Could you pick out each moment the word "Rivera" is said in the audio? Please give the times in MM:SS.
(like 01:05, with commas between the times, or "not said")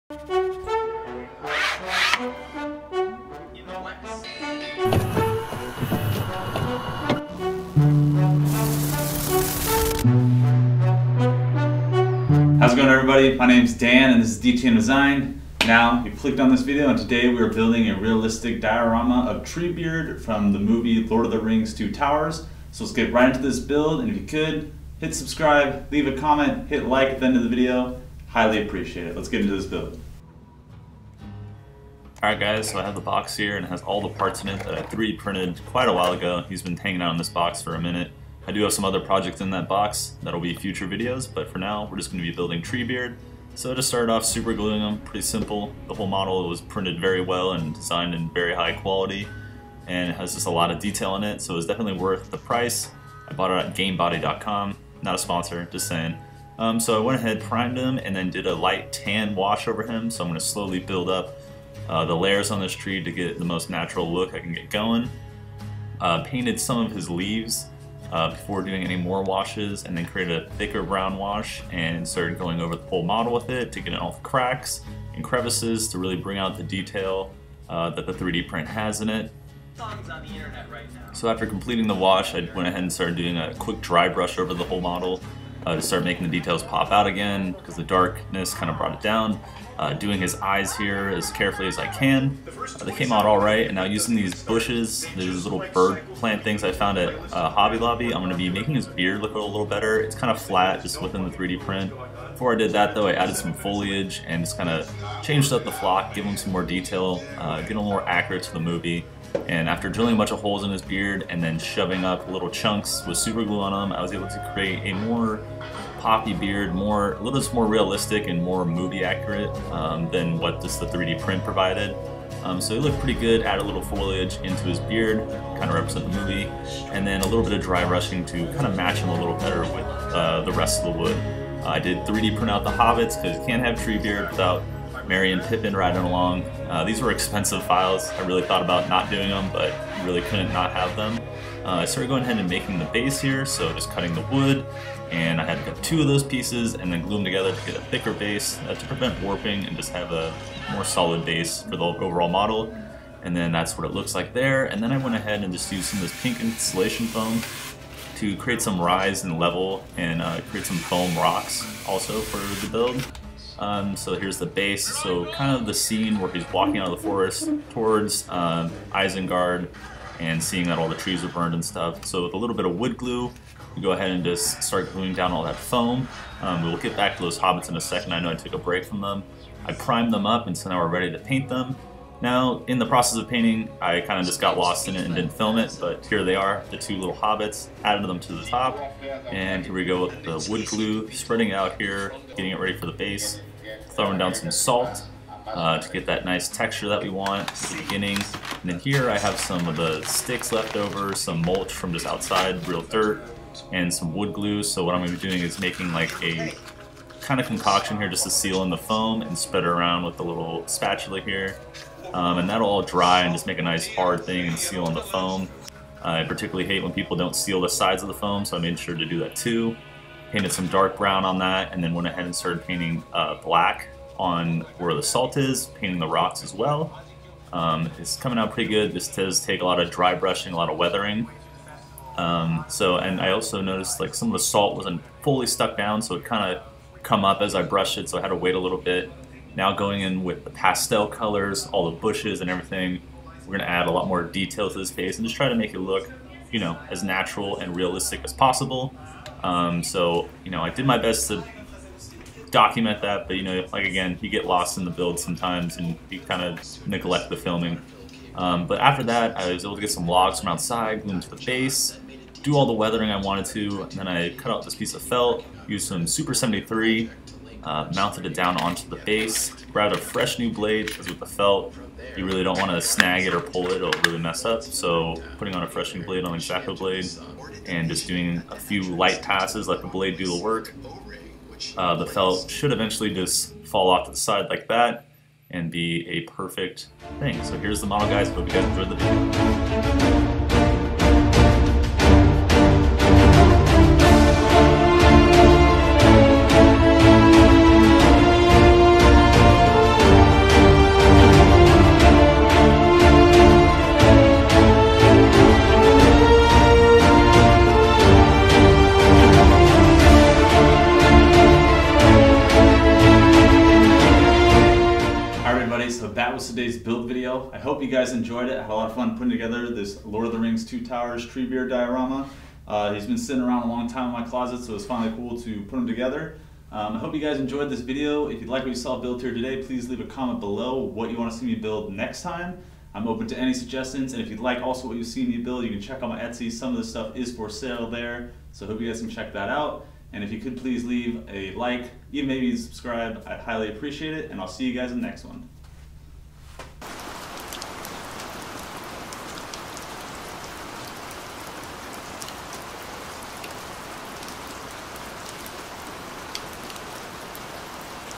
not said.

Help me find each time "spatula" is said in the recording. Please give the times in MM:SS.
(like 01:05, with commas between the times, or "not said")
03:30.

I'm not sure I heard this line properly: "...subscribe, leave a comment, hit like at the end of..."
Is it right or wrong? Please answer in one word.
right.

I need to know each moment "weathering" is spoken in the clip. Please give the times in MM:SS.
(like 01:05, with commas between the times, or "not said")
03:50, 04:22.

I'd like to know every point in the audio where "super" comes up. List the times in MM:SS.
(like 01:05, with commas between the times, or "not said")
00:44, 01:53, 04:26.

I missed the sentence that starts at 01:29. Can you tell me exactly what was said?
Uh, doing his eyes here as carefully as I can.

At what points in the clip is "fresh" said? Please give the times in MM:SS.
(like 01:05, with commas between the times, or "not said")
04:29, 04:35.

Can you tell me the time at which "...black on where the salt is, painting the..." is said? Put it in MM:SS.
03:43.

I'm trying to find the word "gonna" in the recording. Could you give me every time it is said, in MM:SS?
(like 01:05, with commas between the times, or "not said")
04:03.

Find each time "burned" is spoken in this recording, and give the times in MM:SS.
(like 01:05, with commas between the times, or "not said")
02:51.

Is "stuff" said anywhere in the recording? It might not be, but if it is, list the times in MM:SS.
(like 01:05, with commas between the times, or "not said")
02:51, 05:36.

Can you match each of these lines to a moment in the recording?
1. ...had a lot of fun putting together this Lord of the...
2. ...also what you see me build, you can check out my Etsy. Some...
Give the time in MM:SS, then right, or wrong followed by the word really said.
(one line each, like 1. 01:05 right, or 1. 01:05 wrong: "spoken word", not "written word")
1. 05:18 right
2. 05:34 right.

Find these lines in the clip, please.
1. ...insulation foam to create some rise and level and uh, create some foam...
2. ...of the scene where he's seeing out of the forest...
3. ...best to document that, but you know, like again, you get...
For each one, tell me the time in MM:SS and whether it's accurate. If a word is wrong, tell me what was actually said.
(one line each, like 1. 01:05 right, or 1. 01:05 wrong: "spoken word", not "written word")
1. 02:36 right
2. 02:45 wrong: "walking", not "seeing"
3. 04:10 right.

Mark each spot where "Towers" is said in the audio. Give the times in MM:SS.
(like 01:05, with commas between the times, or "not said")
00:21, 05:20.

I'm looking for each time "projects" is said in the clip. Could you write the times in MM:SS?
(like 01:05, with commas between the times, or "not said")
00:38.